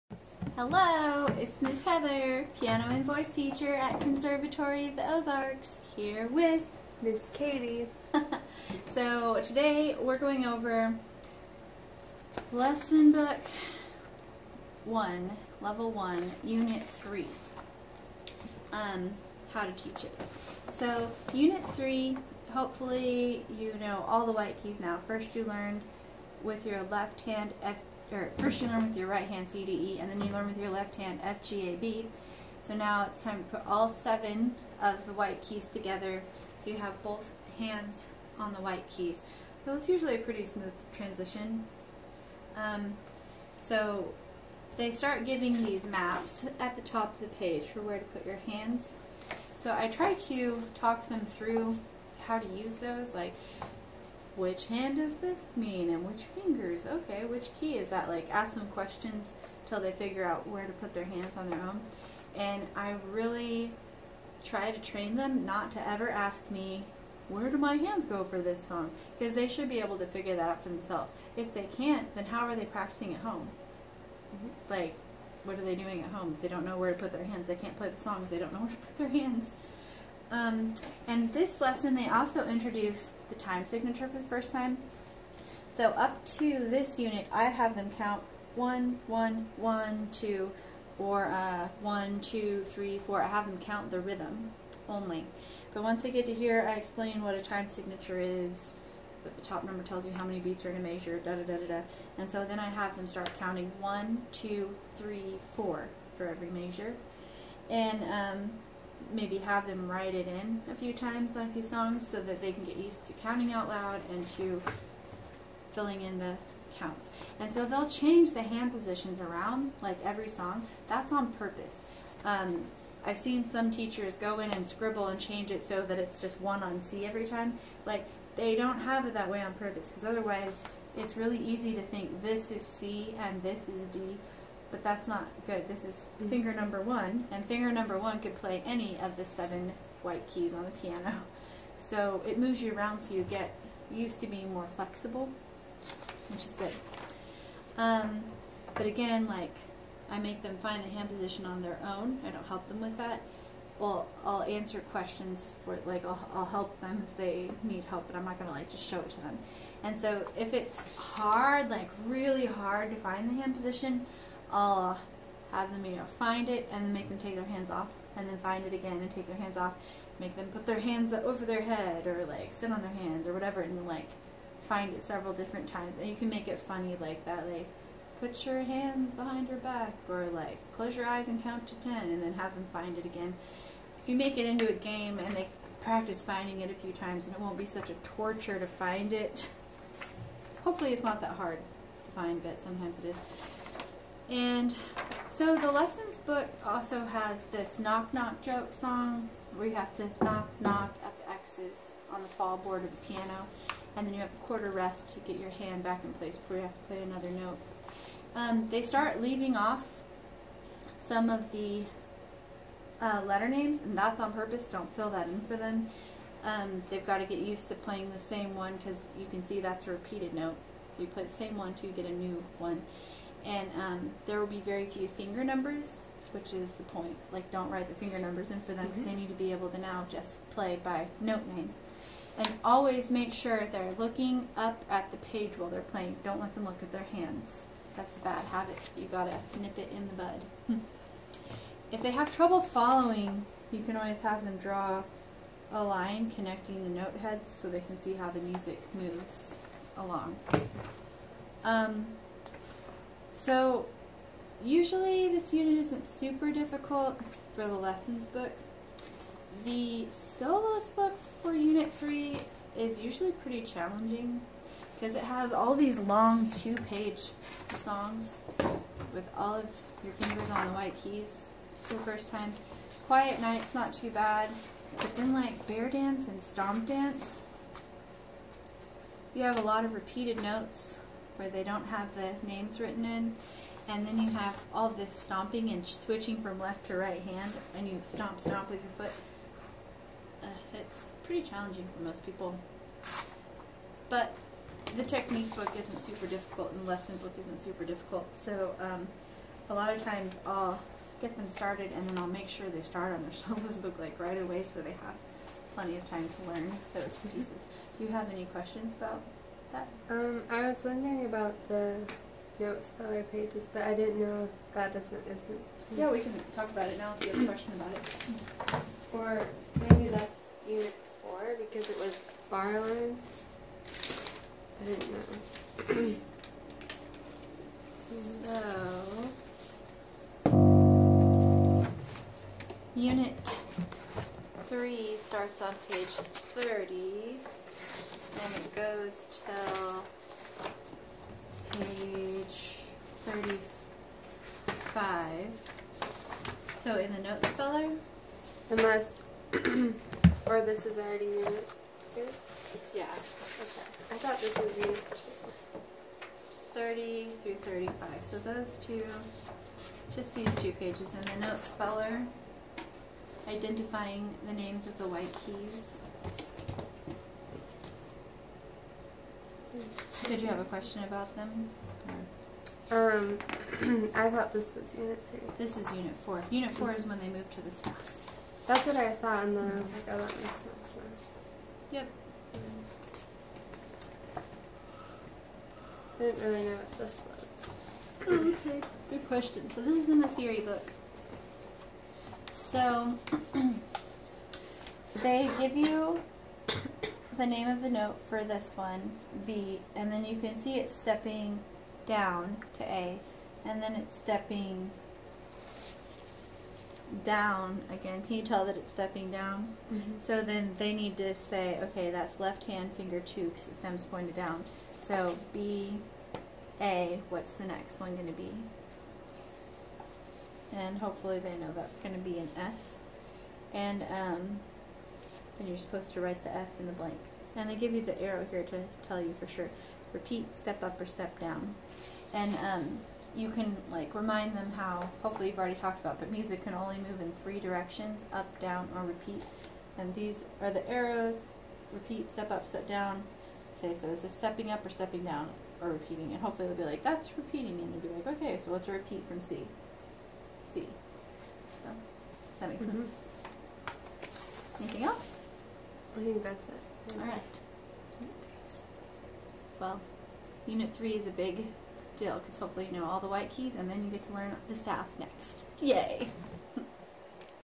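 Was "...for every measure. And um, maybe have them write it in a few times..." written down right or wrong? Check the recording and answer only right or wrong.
right.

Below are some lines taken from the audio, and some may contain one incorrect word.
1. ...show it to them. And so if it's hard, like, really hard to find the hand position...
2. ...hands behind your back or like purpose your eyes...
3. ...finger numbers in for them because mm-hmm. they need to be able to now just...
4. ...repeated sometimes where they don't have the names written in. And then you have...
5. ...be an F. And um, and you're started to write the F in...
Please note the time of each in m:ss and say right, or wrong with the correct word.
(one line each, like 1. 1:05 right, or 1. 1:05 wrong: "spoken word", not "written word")
1. 2:38 right
2. 2:58 wrong: "close", not "purpose"
3. 3:47 right
4. 4:39 wrong: "notes", not "sometimes"
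5. 7:02 wrong: "supposed", not "started".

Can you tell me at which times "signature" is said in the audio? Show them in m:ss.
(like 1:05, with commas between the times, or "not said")
1:23, 1:37.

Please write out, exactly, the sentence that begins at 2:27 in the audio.
Um, but again, like, I make them find the hand position on their own.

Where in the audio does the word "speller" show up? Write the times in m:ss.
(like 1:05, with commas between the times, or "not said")
5:12, 5:47, 6:01.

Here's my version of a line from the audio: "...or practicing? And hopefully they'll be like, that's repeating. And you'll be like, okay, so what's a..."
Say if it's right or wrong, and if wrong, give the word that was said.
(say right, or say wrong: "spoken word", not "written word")
wrong: "repeating", not "practicing".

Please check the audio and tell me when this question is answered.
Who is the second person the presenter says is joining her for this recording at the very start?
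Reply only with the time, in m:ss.
0:07.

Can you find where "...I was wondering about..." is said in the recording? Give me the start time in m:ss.
5:10.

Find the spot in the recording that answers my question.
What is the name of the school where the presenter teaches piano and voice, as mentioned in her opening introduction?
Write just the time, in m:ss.
0:04.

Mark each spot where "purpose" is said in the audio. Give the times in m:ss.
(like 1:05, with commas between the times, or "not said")
2:01, 2:09, 3:34.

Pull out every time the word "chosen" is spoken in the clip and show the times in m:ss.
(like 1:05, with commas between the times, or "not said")
not said.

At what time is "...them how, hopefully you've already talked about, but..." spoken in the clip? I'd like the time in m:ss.
7:14.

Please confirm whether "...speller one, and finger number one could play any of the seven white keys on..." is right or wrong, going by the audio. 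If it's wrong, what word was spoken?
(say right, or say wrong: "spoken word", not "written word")
wrong: "number", not "speller".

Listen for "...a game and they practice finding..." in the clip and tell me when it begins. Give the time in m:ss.
3:04.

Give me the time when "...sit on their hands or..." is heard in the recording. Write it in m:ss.
2:52.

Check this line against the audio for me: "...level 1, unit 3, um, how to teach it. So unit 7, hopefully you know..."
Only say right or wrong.
wrong.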